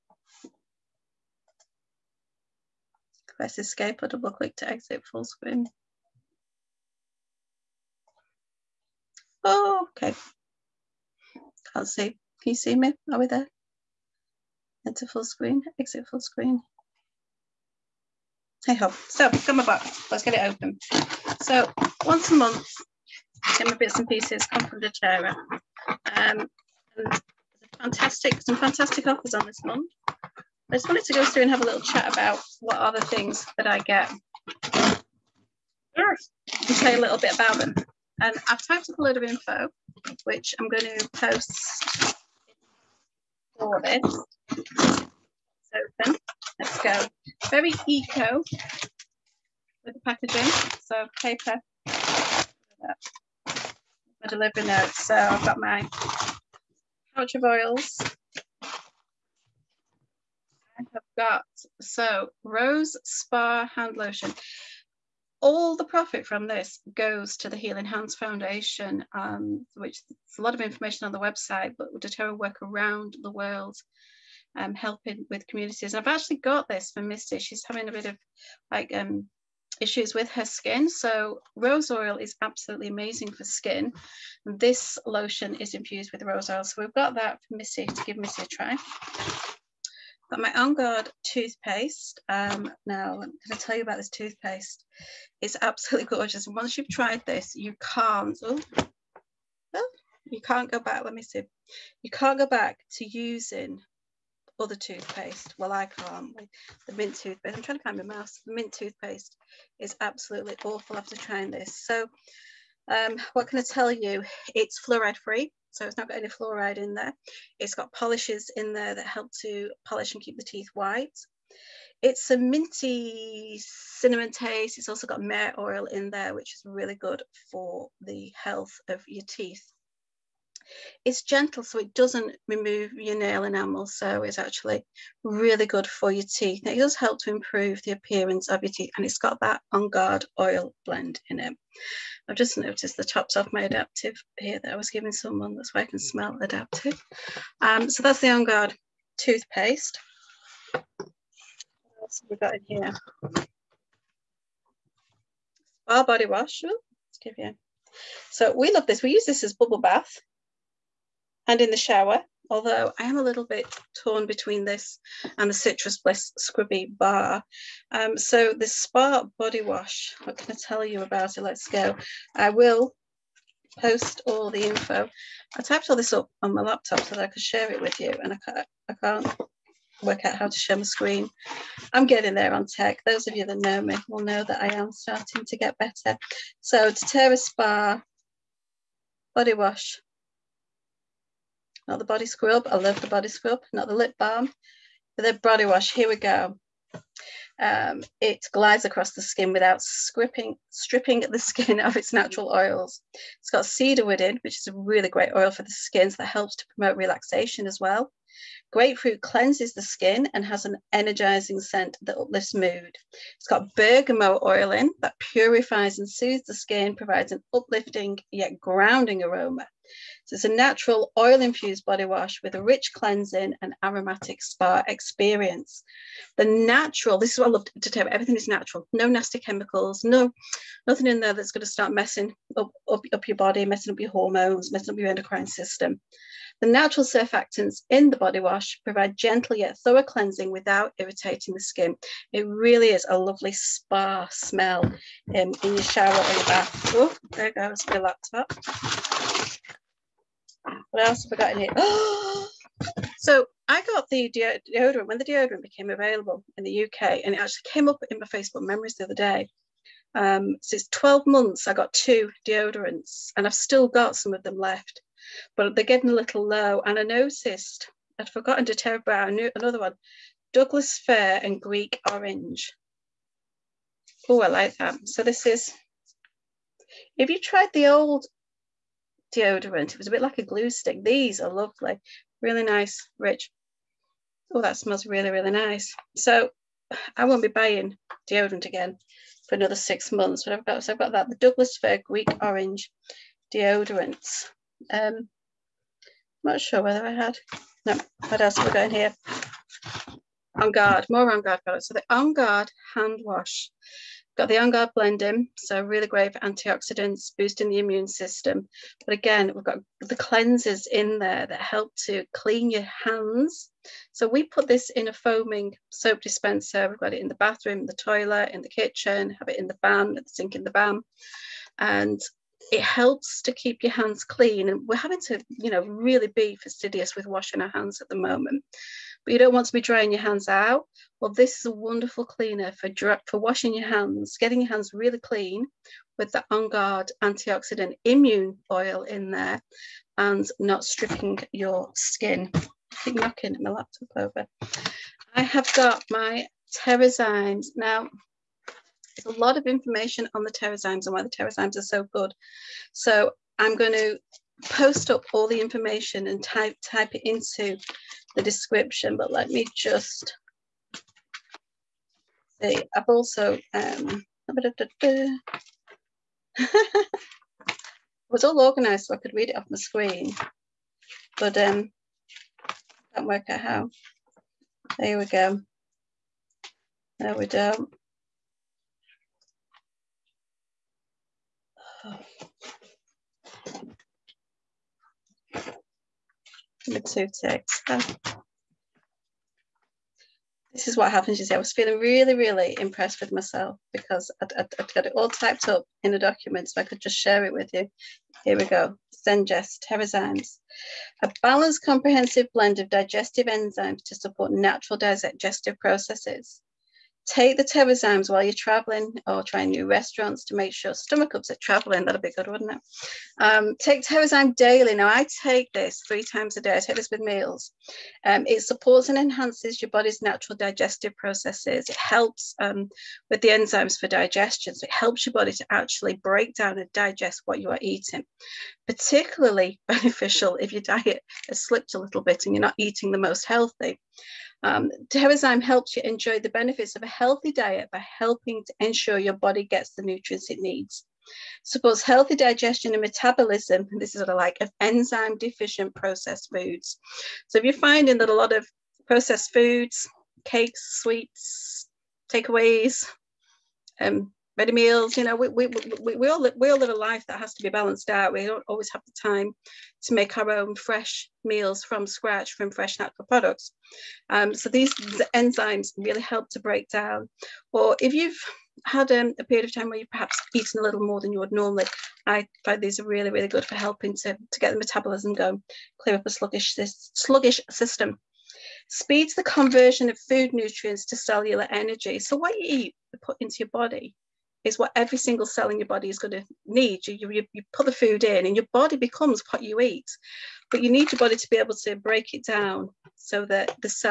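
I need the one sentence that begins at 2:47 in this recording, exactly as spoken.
Um, so the Spa Body Wash, what can I tell you about it?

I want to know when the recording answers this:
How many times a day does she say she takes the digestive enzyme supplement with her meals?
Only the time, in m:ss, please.
6:56.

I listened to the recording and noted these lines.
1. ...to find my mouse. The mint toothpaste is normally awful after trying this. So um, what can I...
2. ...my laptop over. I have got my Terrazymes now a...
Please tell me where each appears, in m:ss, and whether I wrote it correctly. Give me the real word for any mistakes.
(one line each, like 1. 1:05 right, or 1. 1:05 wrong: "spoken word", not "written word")
1. 1:47 wrong: "absolutely", not "normally"
2. 5:43 right.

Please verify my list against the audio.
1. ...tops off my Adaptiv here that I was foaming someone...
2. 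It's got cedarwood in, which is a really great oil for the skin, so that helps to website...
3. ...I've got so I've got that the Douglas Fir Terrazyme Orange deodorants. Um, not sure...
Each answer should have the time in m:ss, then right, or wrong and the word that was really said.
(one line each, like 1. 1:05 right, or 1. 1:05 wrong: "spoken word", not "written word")
1. 2:23 wrong: "giving", not "foaming"
2. 3:23 wrong: "promote", not "website"
3. 4:50 wrong: "Greek", not "Terrazyme".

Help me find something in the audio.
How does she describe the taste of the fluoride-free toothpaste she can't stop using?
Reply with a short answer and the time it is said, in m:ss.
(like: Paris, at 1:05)
Minty cinnamon, at 2:02.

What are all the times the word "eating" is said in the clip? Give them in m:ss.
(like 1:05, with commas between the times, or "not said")
7:07, 7:12.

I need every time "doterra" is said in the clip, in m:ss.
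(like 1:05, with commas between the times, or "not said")
1:11, 3:06.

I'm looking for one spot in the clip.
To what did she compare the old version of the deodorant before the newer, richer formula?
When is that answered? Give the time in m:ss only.
4:40.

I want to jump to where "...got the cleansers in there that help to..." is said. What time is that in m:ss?
5:09.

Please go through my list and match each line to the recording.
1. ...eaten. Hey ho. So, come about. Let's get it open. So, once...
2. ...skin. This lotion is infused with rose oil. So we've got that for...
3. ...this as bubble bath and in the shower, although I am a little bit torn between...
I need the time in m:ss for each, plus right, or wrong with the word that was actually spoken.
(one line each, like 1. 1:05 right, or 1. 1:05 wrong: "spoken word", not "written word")
1. 0:16 wrong: "screen", not "eaten"
2. 1:23 right
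3. 2:39 right.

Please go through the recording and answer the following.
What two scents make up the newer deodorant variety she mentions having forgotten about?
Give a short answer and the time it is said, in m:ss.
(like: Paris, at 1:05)
Douglas fir and Greek orange, at 4:30.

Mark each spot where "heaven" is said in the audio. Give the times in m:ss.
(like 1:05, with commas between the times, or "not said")
not said.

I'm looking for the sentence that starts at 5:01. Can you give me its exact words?
So the on guard hand wash.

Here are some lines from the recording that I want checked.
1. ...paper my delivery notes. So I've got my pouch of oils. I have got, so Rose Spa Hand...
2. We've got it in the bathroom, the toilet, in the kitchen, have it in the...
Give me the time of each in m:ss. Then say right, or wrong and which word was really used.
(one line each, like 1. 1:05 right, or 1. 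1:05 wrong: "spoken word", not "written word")
1. 0:51 right
2. 5:16 right.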